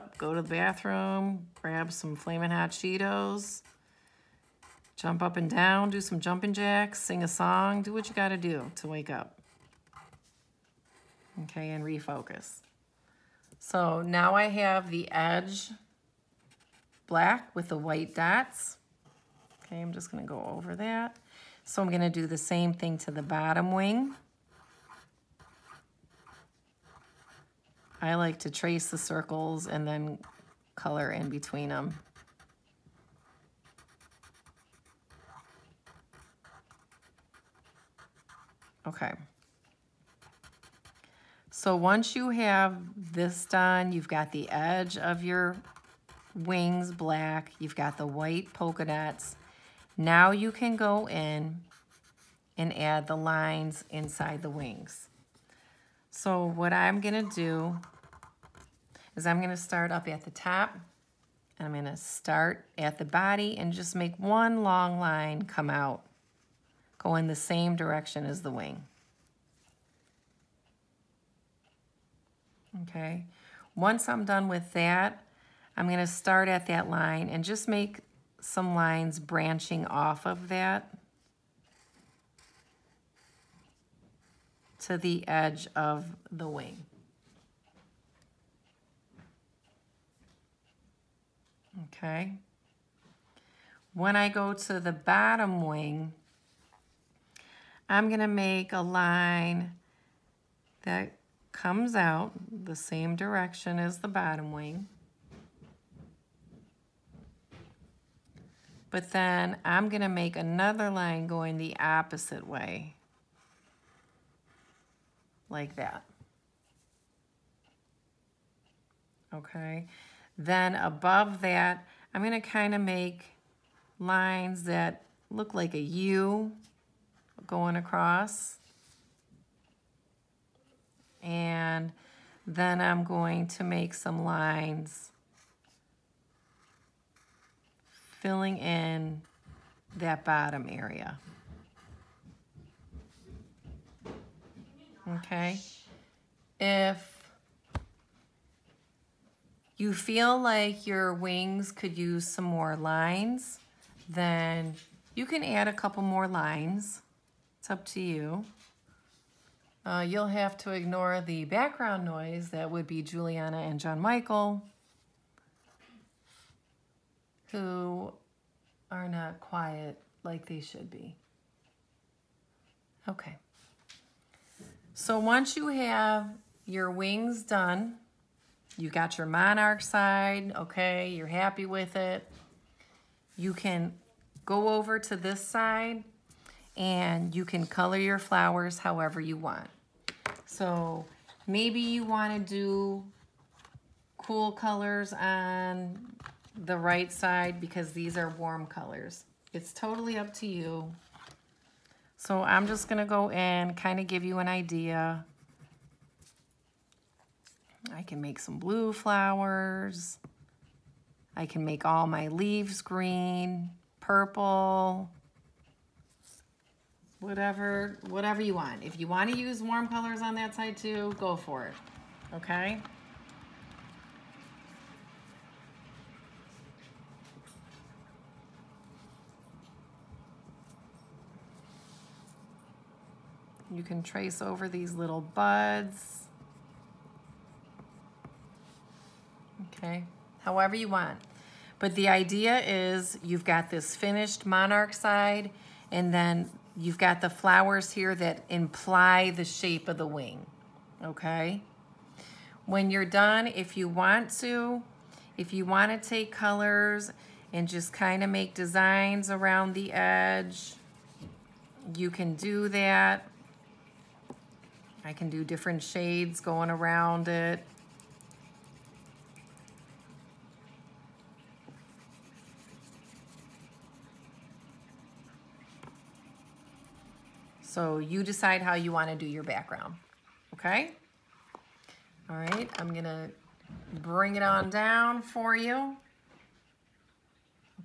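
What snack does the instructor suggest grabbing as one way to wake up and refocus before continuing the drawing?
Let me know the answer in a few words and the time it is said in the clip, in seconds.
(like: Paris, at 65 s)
Flamin' Hot Cheetos, at 2 s.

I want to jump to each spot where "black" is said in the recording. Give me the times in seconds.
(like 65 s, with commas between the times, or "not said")
17 s, 46 s.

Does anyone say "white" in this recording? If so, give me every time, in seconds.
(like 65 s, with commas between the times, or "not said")
17 s, 48 s.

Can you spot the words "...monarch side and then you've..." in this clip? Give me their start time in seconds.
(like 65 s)
244 s.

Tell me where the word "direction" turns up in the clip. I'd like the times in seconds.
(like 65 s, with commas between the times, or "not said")
67 s, 103 s.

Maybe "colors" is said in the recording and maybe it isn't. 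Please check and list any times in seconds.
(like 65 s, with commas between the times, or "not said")
30 s, 187 s, 194 s, 198 s, 219 s, 256 s.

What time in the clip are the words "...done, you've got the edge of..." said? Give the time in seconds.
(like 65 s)
43 s.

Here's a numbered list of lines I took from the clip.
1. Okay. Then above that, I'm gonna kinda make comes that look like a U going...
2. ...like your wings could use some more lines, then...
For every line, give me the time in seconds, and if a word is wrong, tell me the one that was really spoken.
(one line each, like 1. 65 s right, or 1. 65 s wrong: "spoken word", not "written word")
1. 119 s wrong: "lines", not "comes"
2. 150 s right.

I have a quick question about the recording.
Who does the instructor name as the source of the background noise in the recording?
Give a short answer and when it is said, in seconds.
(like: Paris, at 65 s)
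Juliana and John Michael, at 163 s.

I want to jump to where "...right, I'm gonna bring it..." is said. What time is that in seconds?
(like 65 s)
282 s.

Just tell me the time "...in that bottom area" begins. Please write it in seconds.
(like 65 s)
138 s.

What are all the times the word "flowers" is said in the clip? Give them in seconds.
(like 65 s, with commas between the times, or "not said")
188 s, 208 s, 247 s.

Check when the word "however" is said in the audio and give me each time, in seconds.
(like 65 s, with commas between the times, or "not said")
188 s, 240 s.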